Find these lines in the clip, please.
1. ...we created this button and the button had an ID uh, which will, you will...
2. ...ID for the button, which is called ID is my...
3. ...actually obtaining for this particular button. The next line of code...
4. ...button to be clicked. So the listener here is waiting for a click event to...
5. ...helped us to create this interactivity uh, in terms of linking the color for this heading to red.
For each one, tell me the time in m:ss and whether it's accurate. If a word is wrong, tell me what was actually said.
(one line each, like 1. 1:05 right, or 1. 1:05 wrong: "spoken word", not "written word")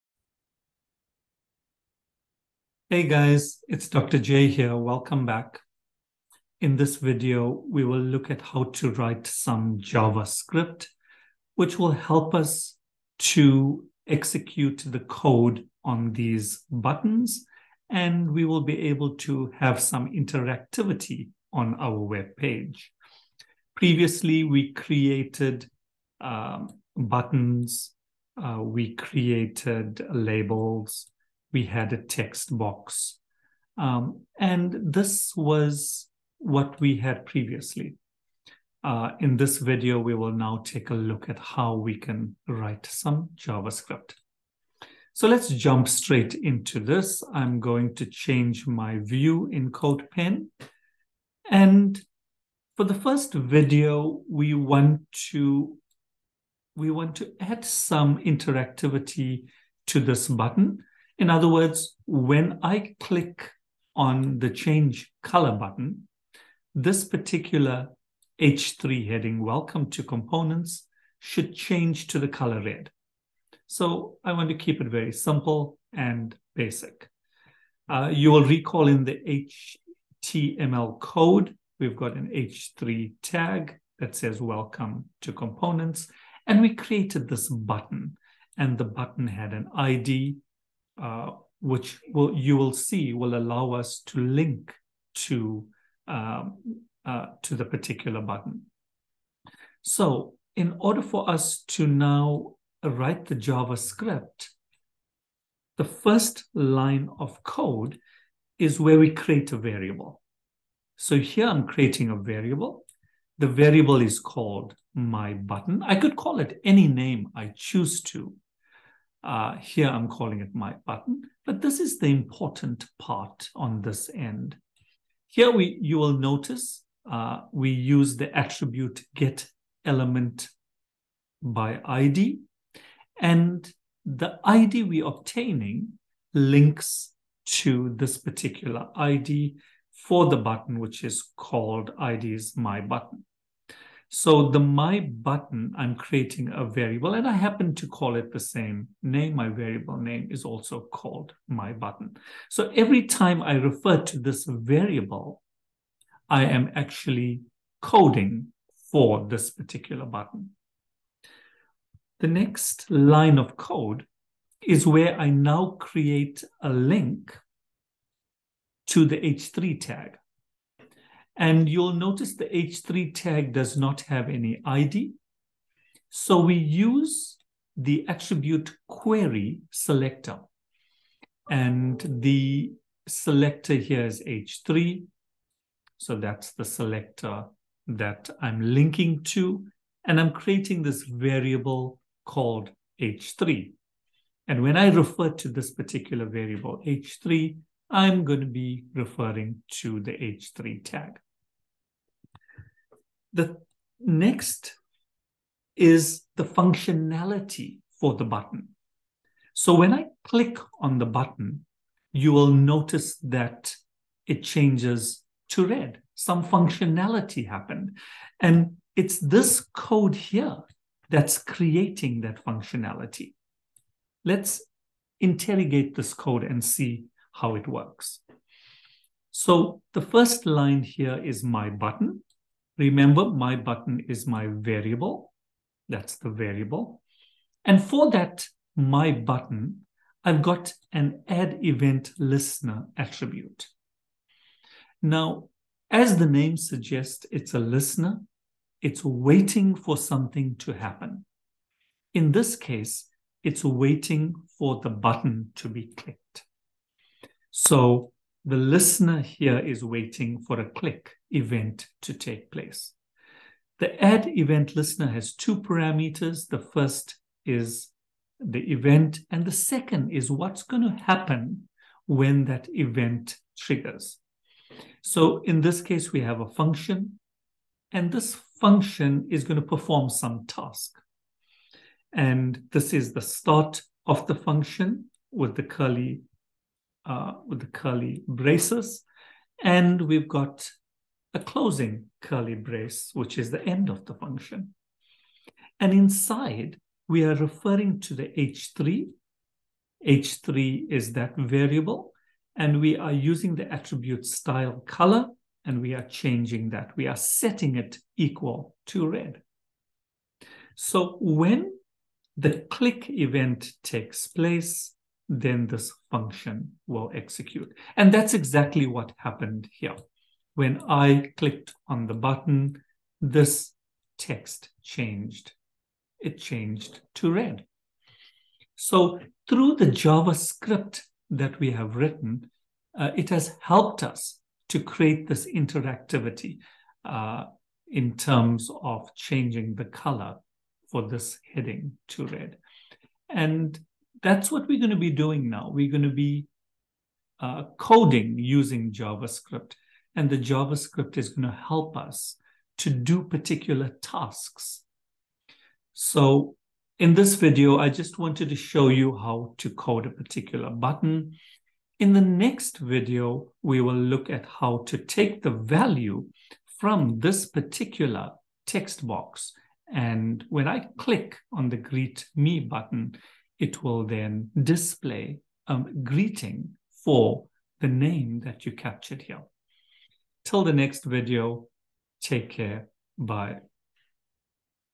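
1. 1:26 right
2. 2:18 right
3. 2:36 wrong: "coding", not "obtaining"
4. 4:14 right
5. 5:33 wrong: "changing", not "linking".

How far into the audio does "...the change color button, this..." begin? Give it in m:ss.
1:04.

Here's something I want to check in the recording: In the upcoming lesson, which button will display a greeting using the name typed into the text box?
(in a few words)
Greet Me.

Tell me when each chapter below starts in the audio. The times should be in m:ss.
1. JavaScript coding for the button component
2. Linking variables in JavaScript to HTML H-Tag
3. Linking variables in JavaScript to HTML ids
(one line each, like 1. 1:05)
1. 3:22
2. 2:40
3. 1:40.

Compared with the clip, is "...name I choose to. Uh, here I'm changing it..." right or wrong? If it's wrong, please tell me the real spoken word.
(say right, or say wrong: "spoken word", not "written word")
wrong: "calling", not "changing".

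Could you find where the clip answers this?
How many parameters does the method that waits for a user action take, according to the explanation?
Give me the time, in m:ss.
4:25.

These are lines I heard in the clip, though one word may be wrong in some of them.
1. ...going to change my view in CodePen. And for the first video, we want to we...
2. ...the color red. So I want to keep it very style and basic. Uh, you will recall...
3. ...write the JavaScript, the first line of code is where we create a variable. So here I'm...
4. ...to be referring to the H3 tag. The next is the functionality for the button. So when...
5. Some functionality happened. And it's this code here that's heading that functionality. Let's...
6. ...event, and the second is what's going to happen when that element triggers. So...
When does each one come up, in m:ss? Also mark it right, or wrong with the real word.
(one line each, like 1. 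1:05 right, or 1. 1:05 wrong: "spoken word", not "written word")
1. 0:47 right
2. 1:12 wrong: "simple", not "style"
3. 1:42 right
4. 3:18 right
5. 3:36 wrong: "creating", not "heading"
6. 4:28 wrong: "event", not "element".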